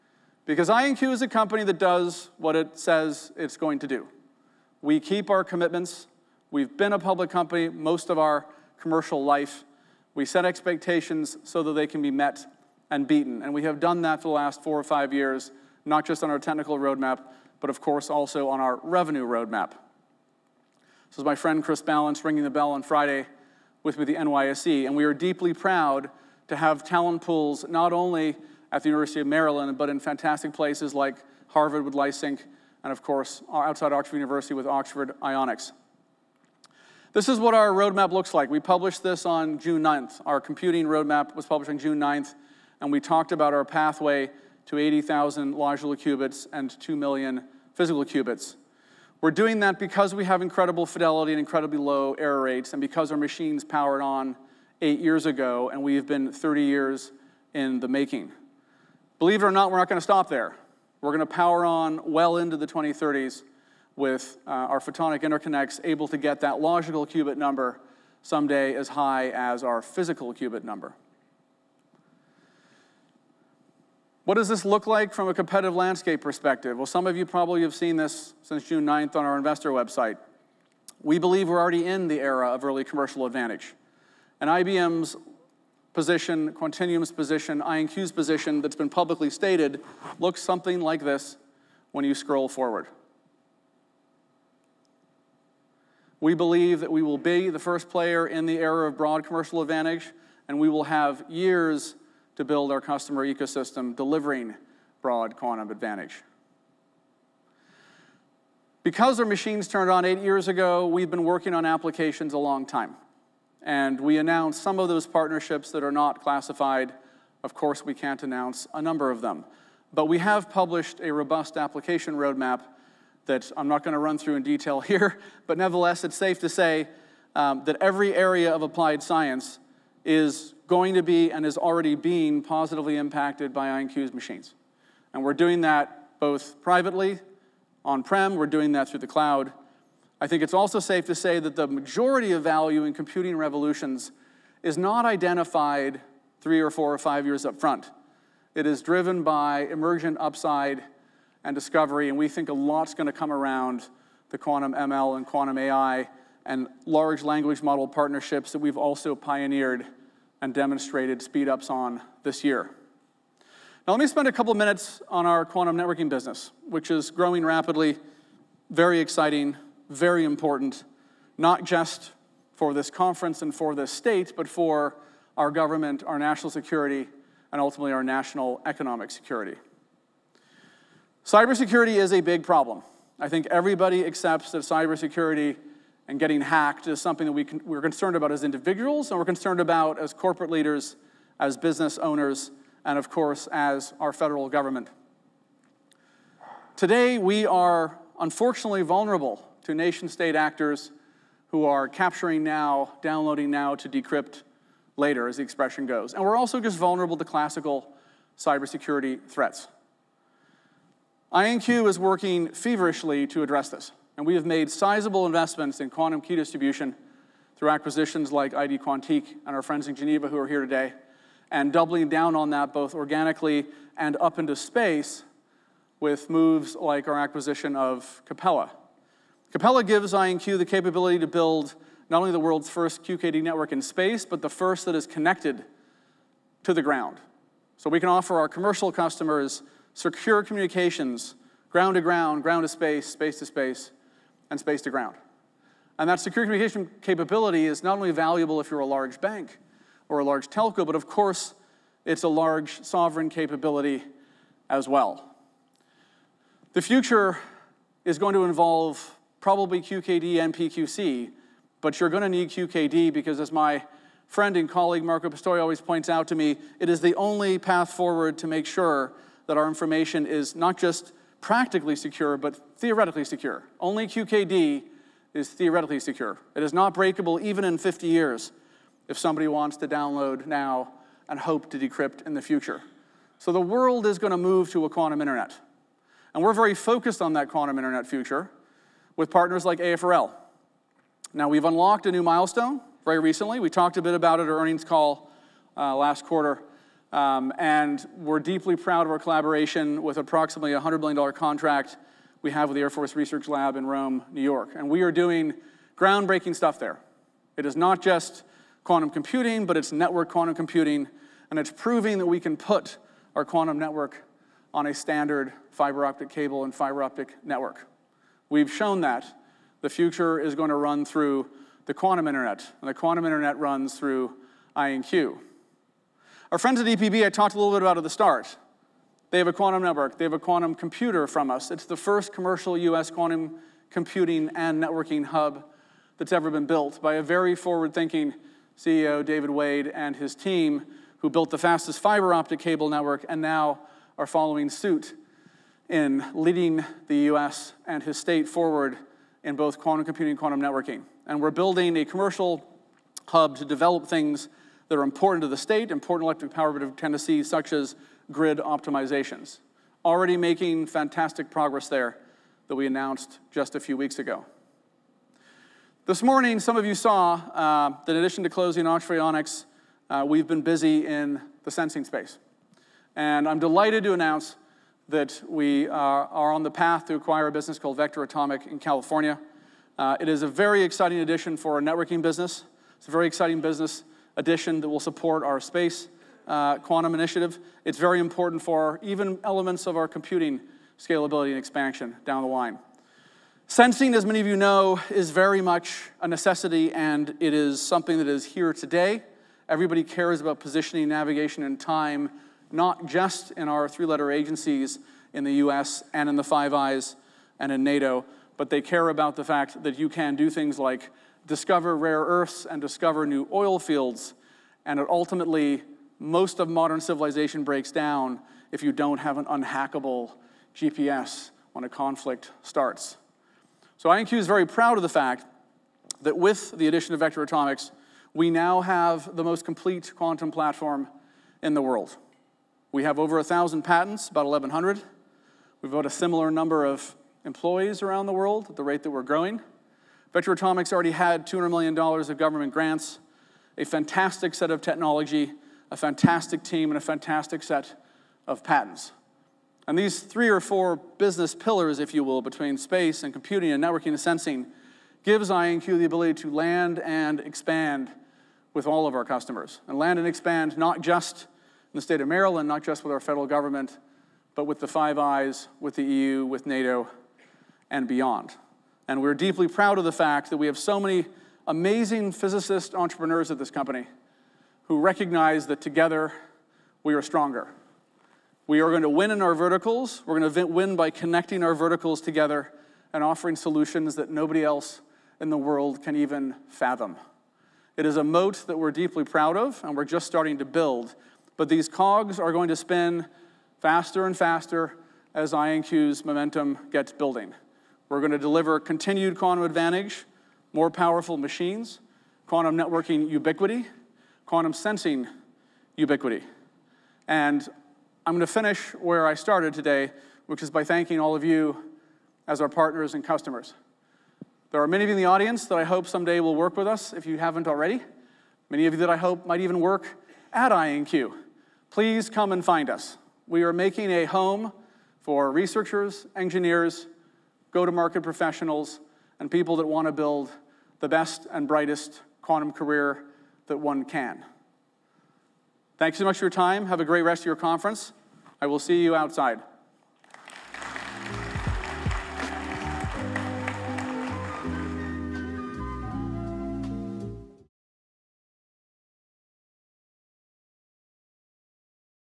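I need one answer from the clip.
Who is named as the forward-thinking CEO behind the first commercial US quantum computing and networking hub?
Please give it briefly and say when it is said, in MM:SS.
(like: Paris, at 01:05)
David Wade, at 05:39.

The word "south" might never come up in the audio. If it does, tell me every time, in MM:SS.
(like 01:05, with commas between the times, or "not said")
not said.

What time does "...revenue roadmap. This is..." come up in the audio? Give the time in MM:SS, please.
00:18.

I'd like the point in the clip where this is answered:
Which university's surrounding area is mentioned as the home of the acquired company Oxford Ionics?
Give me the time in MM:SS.
00:33.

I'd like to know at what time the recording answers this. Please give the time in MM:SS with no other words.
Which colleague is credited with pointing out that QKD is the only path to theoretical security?
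04:25.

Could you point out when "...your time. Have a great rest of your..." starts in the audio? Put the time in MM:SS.
08:56.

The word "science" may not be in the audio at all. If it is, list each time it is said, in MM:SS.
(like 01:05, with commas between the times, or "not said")
02:09.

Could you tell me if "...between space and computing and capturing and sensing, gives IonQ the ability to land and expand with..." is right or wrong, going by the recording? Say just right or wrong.
wrong.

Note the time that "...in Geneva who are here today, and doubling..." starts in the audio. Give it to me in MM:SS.
03:39.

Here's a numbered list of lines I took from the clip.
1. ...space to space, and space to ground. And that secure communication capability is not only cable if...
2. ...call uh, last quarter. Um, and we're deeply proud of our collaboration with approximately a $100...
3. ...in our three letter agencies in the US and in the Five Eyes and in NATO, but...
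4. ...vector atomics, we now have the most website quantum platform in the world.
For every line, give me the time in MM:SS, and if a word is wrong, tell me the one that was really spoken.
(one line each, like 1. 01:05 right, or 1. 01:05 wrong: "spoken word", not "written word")
1. 04:03 wrong: "valuable", not "cable"
2. 04:54 right
3. 06:43 right
4. 07:07 wrong: "complete", not "website".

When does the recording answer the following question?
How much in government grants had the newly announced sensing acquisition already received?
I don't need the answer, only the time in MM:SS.
07:21.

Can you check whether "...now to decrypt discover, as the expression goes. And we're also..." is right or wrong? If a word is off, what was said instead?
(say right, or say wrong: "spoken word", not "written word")
wrong: "later", not "discover".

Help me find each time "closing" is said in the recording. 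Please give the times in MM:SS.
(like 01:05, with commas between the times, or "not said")
06:08.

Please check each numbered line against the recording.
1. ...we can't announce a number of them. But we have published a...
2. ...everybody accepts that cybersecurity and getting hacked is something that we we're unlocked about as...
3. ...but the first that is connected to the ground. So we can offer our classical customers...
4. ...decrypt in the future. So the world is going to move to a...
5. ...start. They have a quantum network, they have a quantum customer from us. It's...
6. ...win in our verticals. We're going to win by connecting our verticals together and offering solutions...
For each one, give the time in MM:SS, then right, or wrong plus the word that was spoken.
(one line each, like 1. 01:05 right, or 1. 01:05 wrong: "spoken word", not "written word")
1. 01:57 right
2. 03:03 wrong: "concerned", not "unlocked"
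3. 03:54 wrong: "commercial", not "classical"
4. 04:41 right
5. 05:28 wrong: "computer", not "customer"
6. 07:59 right.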